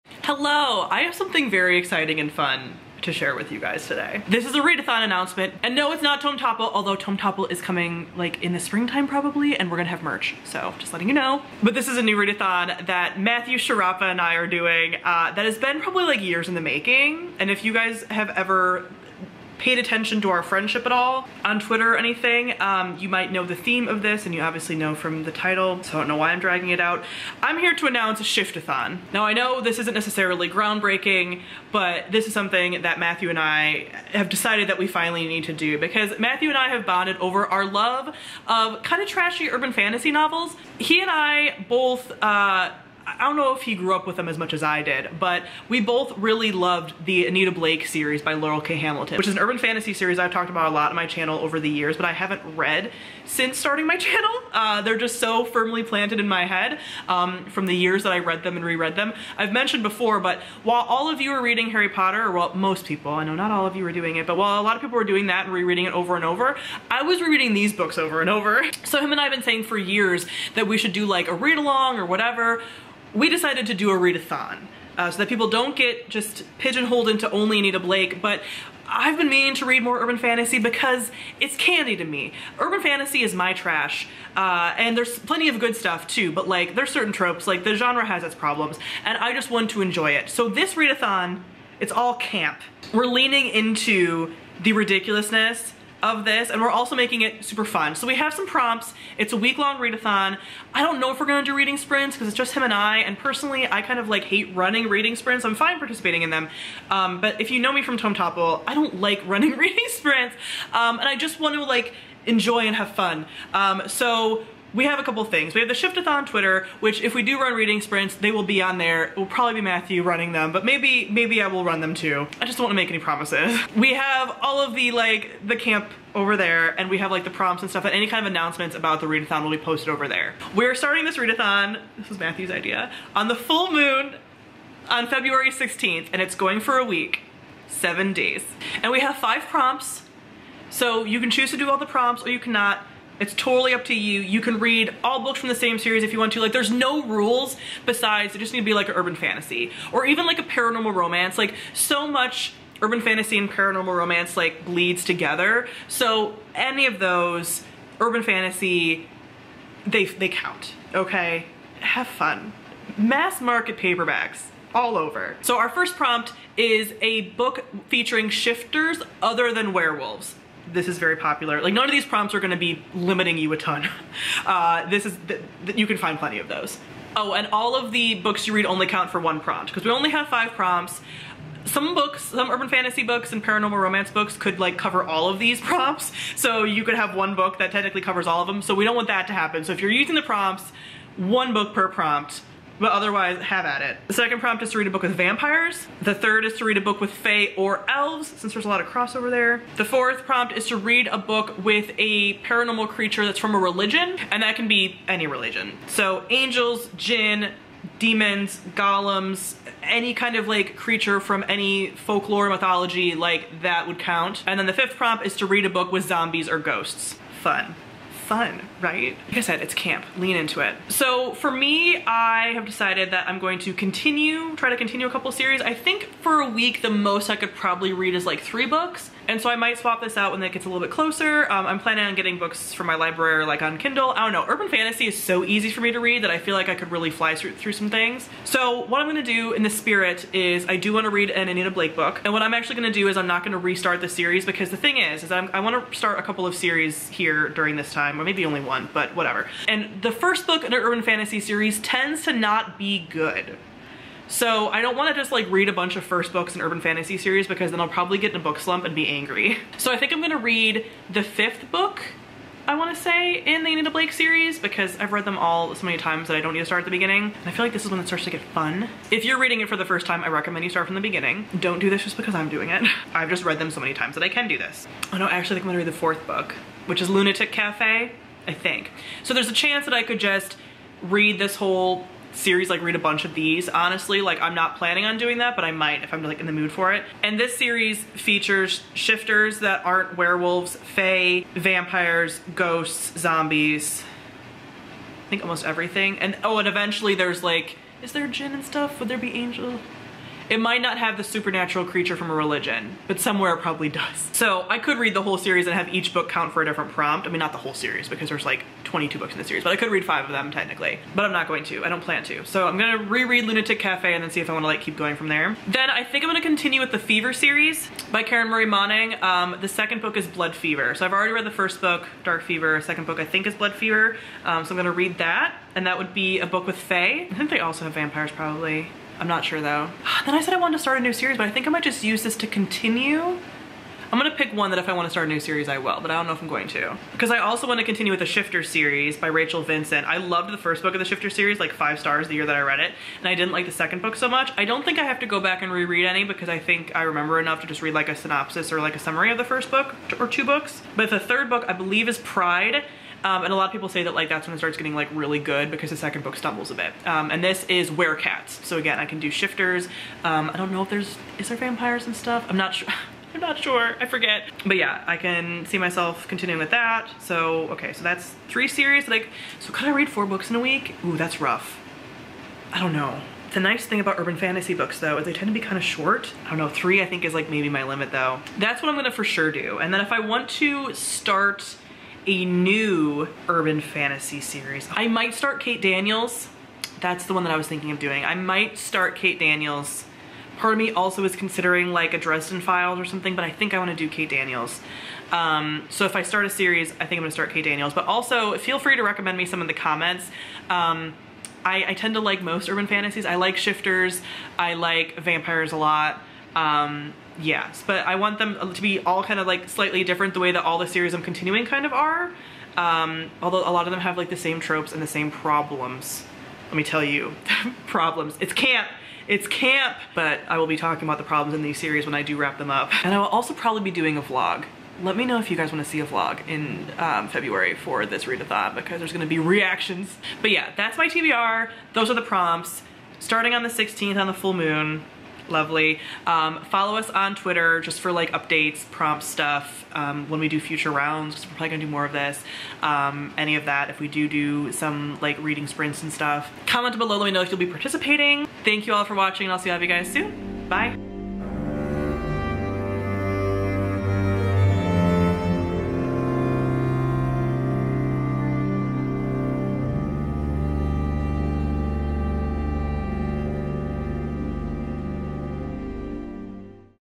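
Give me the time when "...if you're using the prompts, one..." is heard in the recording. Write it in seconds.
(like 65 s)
189 s.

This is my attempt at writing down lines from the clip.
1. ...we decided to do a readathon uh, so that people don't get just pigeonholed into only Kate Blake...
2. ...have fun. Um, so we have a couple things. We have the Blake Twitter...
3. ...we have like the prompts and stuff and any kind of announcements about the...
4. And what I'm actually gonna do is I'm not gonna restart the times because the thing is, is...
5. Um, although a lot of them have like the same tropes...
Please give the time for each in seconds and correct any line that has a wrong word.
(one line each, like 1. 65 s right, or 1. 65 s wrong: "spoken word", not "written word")
1. 73 s wrong: "Anita", not "Kate"
2. 112 s wrong: "Shiftathon", not "Blake"
3. 126 s right
4. 242 s wrong: "series", not "times"
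5. 412 s right.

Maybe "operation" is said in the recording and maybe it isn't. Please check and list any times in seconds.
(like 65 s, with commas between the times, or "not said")
not said.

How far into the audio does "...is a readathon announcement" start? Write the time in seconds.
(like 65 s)
4 s.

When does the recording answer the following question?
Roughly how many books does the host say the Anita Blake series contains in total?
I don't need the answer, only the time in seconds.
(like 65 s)
308 s.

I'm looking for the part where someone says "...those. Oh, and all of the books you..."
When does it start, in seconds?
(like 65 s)
176 s.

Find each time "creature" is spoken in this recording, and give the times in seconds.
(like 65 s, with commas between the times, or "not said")
202 s, 210 s, 301 s.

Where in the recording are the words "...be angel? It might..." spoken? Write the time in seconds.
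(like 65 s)
299 s.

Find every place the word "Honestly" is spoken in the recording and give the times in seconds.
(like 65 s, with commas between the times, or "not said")
283 s.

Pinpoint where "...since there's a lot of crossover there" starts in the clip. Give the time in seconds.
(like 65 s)
198 s.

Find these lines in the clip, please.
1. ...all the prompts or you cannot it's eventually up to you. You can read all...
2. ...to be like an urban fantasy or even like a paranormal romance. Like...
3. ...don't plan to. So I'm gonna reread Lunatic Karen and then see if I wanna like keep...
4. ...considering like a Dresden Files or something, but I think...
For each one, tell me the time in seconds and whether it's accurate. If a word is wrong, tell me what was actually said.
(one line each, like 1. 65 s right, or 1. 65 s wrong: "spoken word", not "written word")
1. 141 s wrong: "totally", not "eventually"
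2. 148 s right
3. 311 s wrong: "Cafe", not "Karen"
4. 391 s right.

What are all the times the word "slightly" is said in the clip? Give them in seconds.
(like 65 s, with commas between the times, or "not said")
409 s.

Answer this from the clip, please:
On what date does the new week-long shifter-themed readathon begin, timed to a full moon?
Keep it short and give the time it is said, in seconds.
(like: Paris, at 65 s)
February 16th, at 135 s.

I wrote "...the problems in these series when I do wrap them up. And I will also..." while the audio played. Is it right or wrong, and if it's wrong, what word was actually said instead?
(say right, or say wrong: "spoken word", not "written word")
right.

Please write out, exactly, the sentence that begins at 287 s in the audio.
And this series features shifters that aren't werewolves, fae, vampires, ghosts, zombies, I think almost everything.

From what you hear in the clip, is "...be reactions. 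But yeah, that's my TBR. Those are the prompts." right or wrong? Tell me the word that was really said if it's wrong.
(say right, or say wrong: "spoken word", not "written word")
right.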